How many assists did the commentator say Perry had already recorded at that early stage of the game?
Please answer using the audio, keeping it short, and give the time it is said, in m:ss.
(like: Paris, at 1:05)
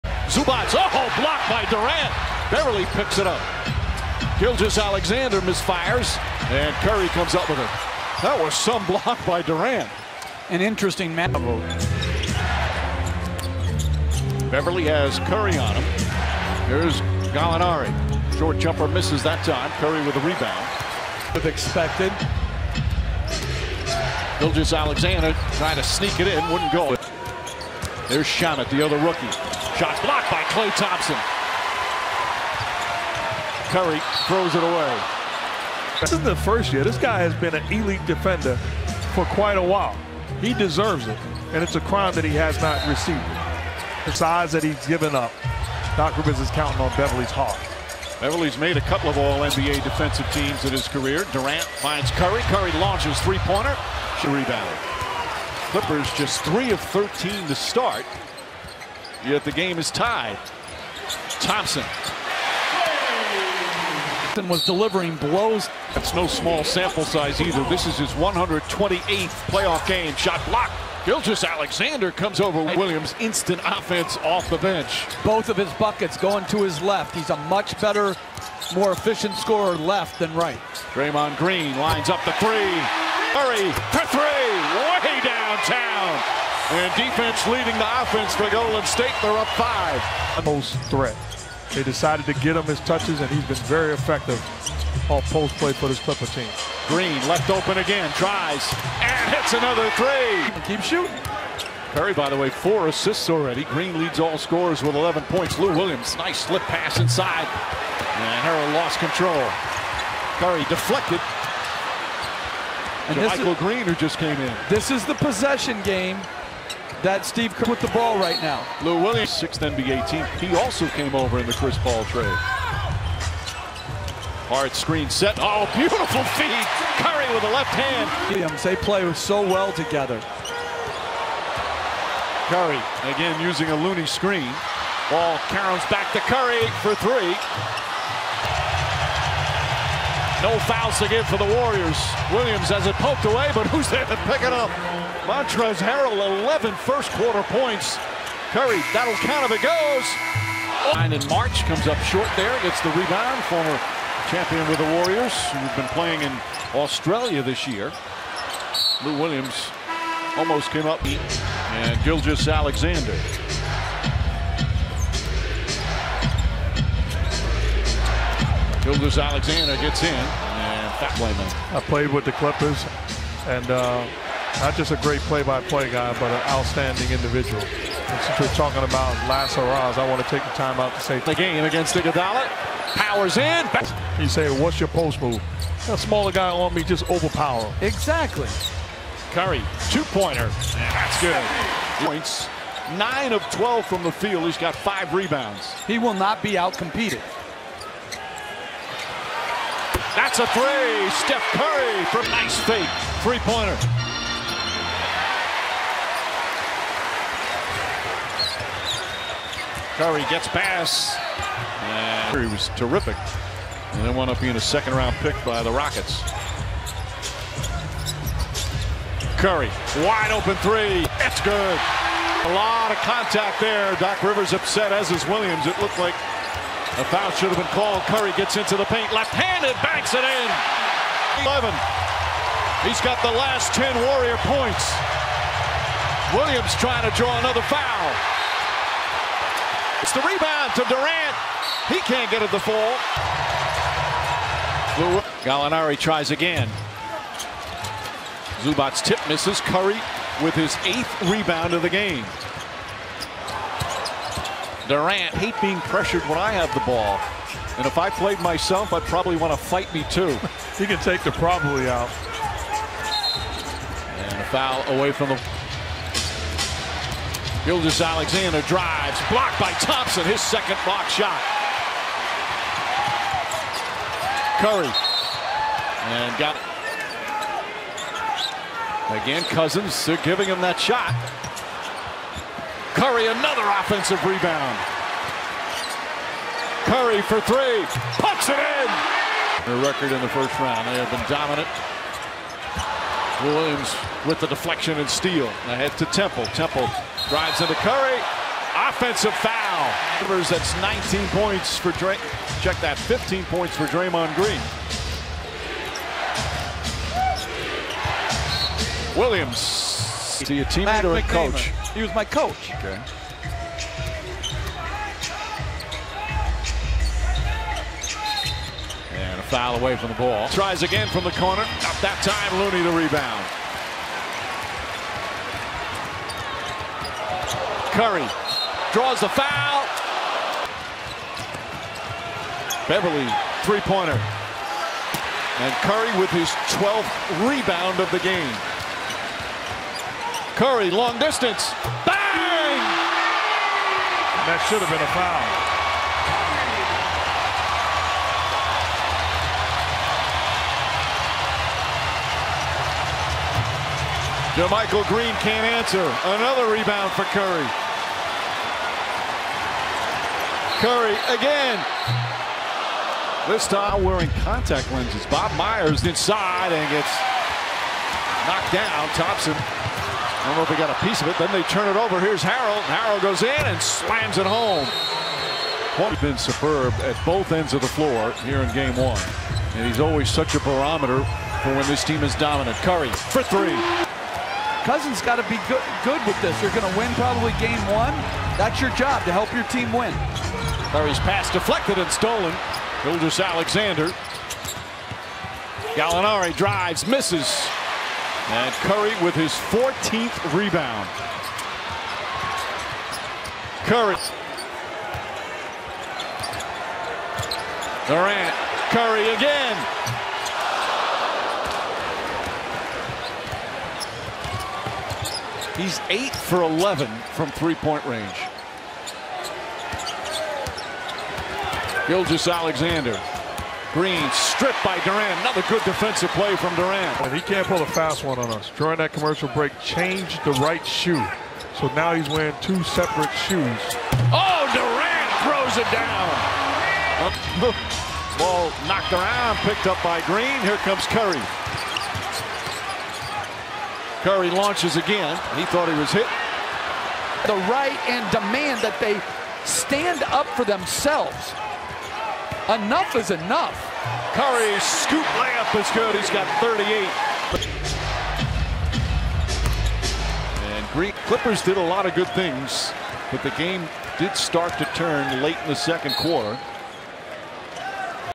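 4, at 1:42.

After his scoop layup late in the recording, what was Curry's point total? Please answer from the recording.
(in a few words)
38.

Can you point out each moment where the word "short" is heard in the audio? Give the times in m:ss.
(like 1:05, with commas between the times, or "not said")
0:18, 2:32.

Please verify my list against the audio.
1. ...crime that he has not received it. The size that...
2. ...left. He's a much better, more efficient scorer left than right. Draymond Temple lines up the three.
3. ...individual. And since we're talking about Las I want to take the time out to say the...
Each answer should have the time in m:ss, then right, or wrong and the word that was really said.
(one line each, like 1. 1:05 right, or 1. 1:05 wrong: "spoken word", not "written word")
1. 0:41 right
2. 1:16 wrong: "Green", not "Temple"
3. 2:57 right.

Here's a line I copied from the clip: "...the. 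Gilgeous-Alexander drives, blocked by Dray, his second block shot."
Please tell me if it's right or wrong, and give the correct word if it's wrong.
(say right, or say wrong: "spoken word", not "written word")
wrong: "Thompson", not "Dray".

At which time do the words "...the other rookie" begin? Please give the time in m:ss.
0:28.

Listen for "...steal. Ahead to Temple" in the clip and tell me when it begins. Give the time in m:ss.
4:55.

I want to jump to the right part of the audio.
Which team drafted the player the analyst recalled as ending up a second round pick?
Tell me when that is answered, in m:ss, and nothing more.
3:35.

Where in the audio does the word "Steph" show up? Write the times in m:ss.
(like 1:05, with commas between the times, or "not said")
3:21.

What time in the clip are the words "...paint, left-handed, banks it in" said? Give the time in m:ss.
3:48.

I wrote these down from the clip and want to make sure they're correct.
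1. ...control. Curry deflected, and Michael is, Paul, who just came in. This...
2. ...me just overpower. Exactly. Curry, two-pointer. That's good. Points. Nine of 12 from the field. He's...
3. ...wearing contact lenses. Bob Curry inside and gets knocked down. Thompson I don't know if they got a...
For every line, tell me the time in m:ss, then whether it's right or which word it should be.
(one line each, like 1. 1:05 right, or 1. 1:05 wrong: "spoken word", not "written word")
1. 1:48 wrong: "Green", not "Paul"
2. 3:06 right
3. 6:04 wrong: "Myers", not "Curry".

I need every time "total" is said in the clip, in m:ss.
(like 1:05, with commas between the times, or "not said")
not said.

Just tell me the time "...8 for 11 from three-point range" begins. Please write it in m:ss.
6:56.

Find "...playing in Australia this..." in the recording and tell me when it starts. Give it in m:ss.
2:35.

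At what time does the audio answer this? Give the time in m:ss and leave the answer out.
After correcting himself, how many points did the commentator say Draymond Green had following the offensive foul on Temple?
5:02.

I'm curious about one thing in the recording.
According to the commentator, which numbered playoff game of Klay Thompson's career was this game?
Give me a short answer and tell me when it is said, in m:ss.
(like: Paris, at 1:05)
128th, at 1:08.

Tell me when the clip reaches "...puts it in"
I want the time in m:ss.
4:48.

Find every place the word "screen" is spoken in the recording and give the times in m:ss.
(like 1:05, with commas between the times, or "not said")
2:04, 2:14.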